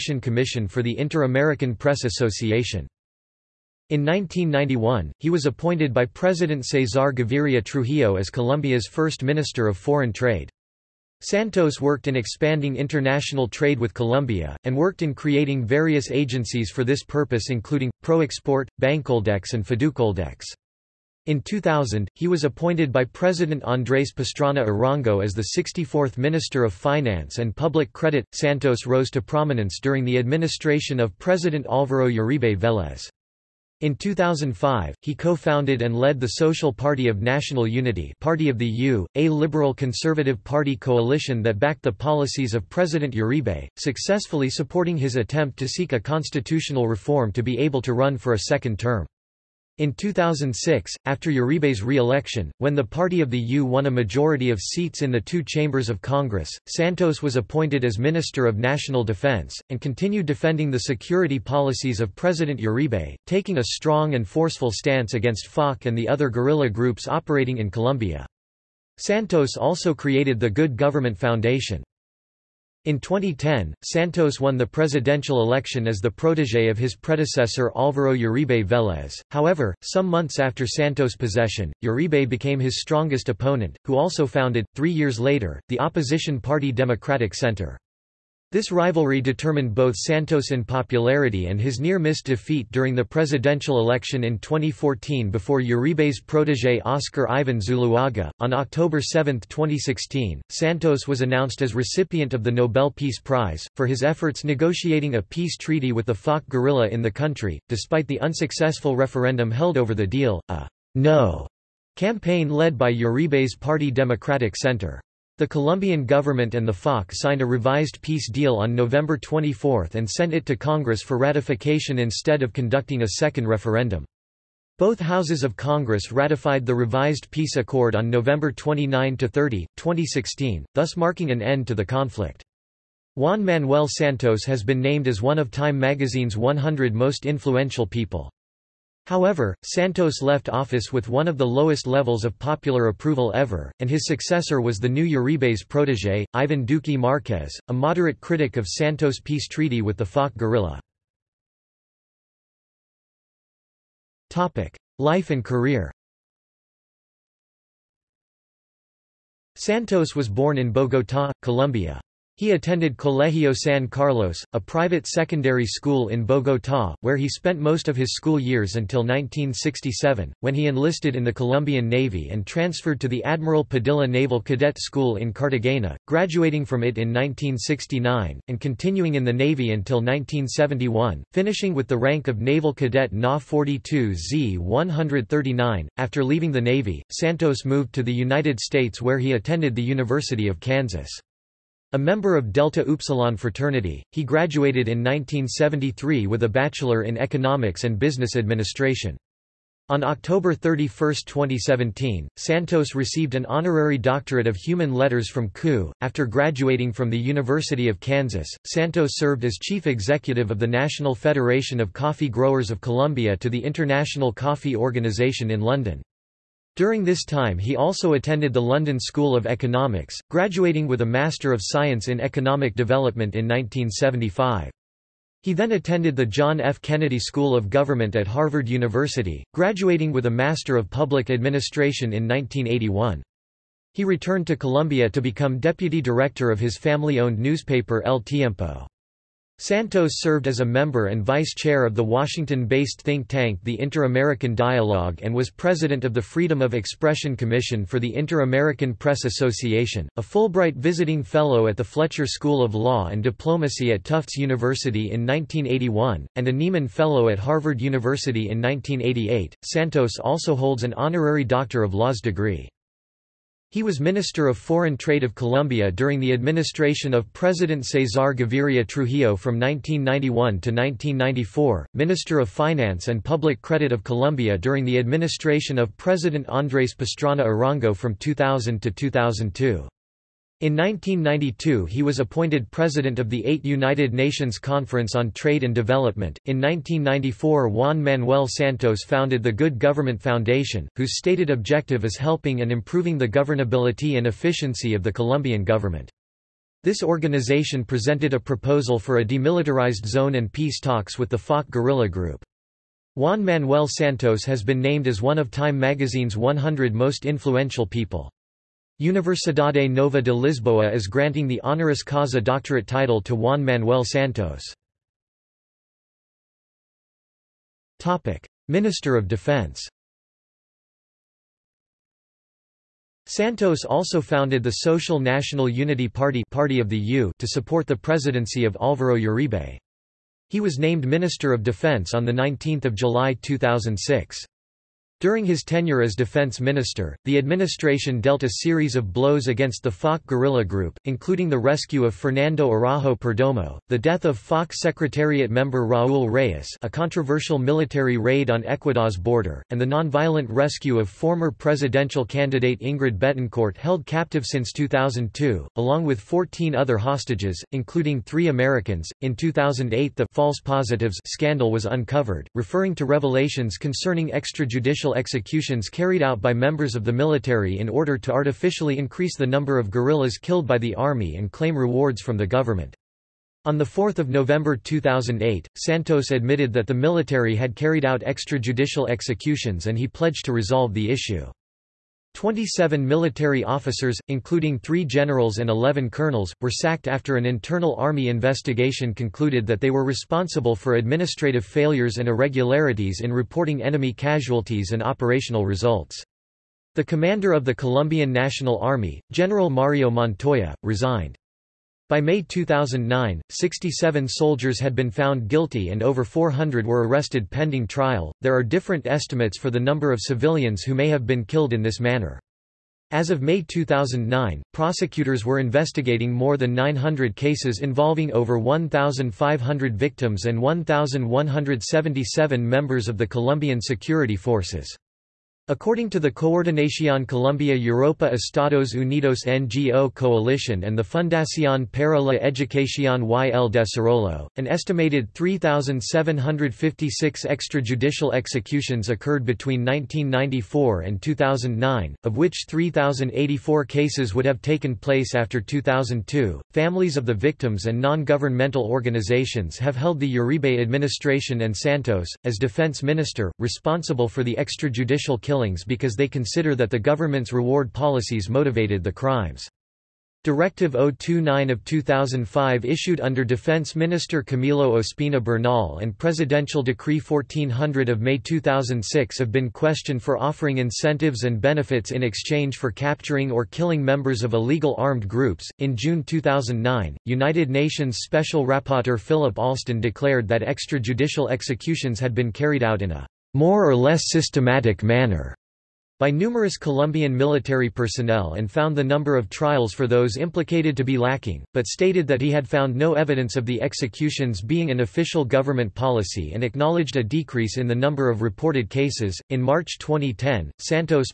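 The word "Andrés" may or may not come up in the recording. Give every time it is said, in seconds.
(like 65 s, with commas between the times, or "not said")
23 s, 276 s.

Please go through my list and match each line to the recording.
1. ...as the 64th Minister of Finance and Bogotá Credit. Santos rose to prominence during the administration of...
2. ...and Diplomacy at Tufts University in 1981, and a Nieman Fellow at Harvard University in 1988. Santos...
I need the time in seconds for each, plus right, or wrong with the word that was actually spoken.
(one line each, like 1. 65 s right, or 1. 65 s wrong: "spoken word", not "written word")
1. 25 s wrong: "Public", not "Bogotá"
2. 253 s right.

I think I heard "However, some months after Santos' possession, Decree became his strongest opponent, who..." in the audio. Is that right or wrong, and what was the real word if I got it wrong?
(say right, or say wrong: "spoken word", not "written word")
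wrong: "Uribe", not "Decree".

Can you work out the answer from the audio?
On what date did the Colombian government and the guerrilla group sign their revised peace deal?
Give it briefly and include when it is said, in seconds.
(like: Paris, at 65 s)
November 24, at 118 s.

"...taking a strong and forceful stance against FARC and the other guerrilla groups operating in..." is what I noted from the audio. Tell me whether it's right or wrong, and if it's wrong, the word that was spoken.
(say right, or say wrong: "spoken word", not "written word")
right.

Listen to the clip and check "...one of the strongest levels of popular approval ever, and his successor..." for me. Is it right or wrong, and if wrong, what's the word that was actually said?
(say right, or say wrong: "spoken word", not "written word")
wrong: "lowest", not "strongest".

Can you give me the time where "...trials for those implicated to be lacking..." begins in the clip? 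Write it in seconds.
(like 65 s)
489 s.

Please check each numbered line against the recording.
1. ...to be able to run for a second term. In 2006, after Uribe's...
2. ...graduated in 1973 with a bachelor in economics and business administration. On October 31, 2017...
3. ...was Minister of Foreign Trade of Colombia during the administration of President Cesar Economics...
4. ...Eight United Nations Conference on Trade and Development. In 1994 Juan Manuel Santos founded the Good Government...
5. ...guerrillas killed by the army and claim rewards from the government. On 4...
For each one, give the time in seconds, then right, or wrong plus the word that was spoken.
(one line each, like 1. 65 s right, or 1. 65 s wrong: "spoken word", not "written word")
1. 47 s right
2. 194 s right
3. 263 s wrong: "Gaviria", not "Economics"
4. 283 s right
5. 369 s right.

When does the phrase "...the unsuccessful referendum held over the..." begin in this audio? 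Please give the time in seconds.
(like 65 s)
108 s.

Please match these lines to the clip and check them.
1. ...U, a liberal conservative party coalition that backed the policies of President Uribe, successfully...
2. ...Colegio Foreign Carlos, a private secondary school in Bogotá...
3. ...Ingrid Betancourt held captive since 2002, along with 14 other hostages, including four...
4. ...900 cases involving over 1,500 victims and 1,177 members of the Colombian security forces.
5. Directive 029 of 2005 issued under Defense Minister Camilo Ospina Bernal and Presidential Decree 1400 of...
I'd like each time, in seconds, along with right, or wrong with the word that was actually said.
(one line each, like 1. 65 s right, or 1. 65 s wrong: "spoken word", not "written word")
1. 38 s right
2. 162 s wrong: "San", not "Foreign"
3. 352 s wrong: "three", not "four"
4. 416 s right
5. 460 s right.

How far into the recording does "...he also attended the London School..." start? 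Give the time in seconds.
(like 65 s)
217 s.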